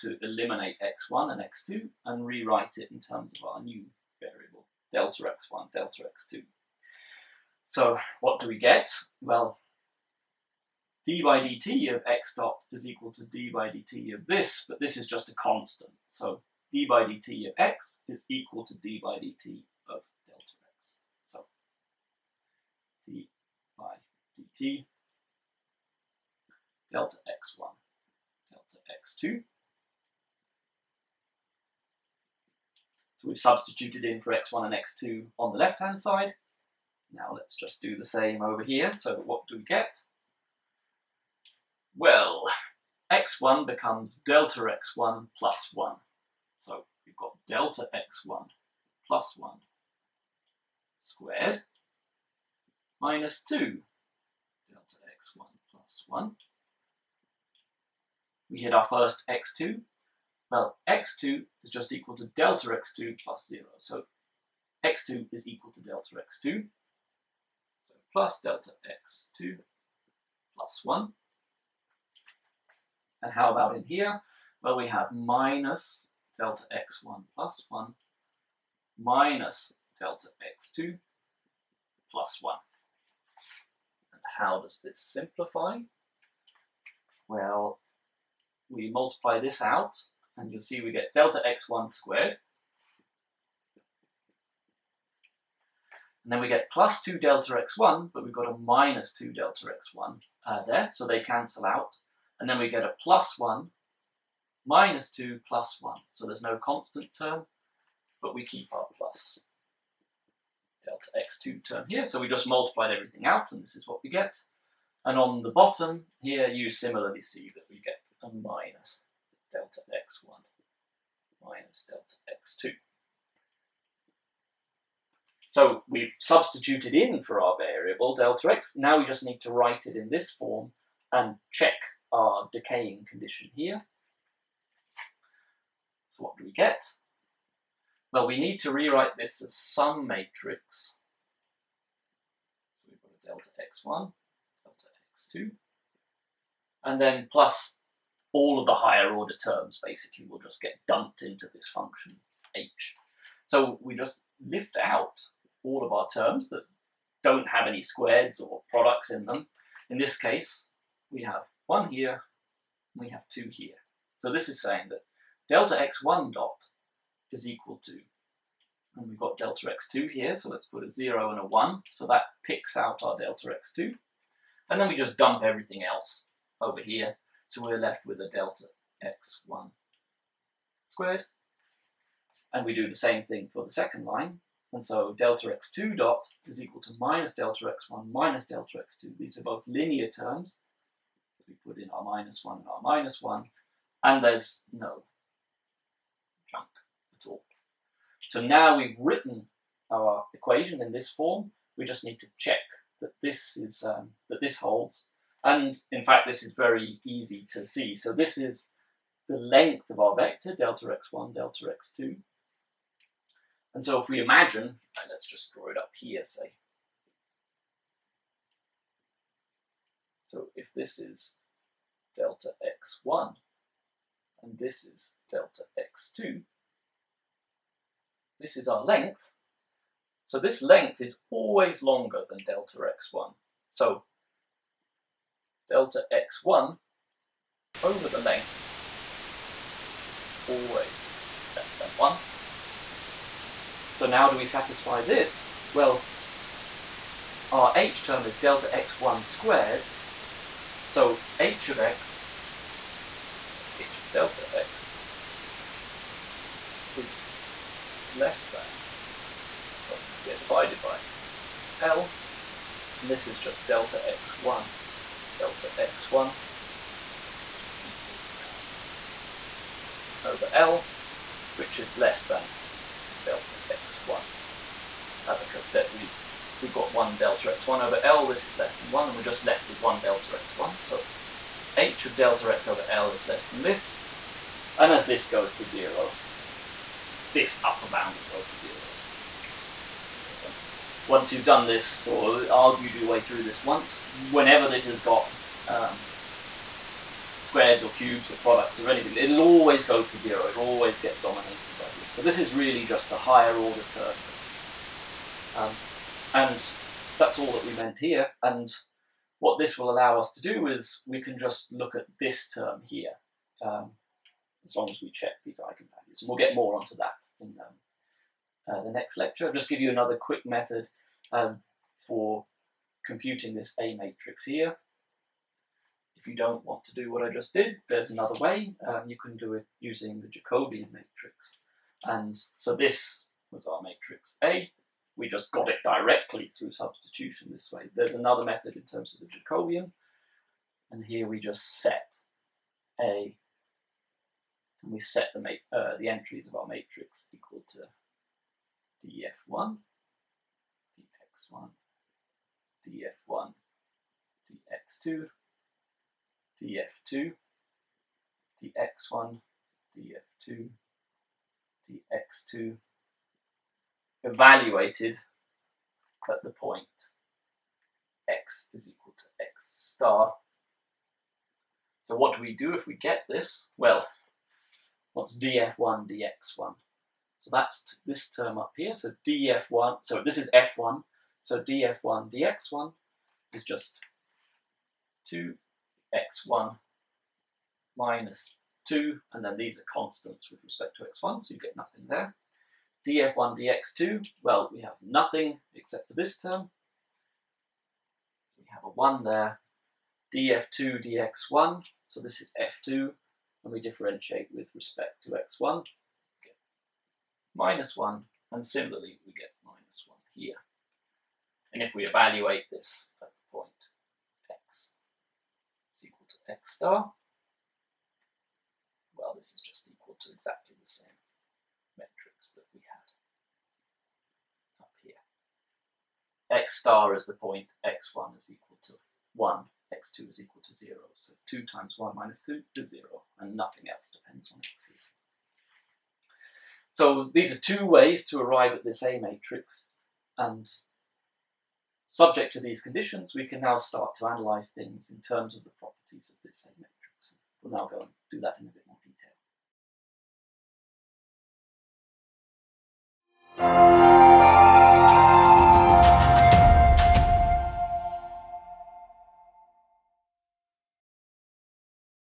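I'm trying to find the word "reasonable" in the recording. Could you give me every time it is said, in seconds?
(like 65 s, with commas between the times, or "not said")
not said.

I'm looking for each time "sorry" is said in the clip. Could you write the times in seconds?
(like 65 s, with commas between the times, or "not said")
253 s.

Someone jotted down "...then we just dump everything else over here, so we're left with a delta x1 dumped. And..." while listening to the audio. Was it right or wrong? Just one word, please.
wrong.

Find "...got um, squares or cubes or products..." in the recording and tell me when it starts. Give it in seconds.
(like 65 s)
295 s.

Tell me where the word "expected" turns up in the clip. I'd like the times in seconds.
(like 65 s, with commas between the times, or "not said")
not said.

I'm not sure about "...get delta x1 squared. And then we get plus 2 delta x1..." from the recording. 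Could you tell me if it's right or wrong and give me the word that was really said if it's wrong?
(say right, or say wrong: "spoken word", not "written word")
right.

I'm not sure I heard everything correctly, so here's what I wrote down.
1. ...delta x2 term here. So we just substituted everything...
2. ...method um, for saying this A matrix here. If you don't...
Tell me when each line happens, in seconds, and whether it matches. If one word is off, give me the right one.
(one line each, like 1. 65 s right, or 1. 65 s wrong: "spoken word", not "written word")
1. 110 s wrong: "multiplied", not "substituted"
2. 320 s wrong: "computing", not "saying".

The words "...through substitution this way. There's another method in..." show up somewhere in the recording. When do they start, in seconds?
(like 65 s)
336 s.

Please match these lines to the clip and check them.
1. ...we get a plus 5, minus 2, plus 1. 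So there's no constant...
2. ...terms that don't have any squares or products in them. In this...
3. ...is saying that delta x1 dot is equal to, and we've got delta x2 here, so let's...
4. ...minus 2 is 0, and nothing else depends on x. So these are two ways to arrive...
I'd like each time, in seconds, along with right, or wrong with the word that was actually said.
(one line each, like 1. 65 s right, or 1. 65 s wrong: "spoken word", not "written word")
1. 102 s wrong: "1", not "5"
2. 156 s right
3. 164 s right
4. 432 s right.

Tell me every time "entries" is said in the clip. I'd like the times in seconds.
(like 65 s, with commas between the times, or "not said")
346 s.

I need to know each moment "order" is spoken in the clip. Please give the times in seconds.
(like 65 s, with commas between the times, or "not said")
149 s, 303 s.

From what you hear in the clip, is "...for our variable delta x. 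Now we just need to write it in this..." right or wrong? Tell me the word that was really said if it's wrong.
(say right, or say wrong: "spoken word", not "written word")
right.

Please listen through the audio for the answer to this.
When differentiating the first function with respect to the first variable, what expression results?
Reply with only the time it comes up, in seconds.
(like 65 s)
385 s.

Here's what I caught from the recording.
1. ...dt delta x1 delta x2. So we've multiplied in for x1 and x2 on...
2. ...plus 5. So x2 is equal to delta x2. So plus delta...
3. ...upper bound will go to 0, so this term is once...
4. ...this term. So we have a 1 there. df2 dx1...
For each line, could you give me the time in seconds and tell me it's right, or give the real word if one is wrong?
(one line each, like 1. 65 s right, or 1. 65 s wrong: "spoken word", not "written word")
1. 24 s wrong: "substituted", not "multiplied"
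2. 63 s wrong: "0", not "5"
3. 287 s right
4. 396 s right.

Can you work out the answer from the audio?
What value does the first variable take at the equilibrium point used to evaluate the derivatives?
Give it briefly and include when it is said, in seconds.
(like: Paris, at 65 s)
1, at 427 s.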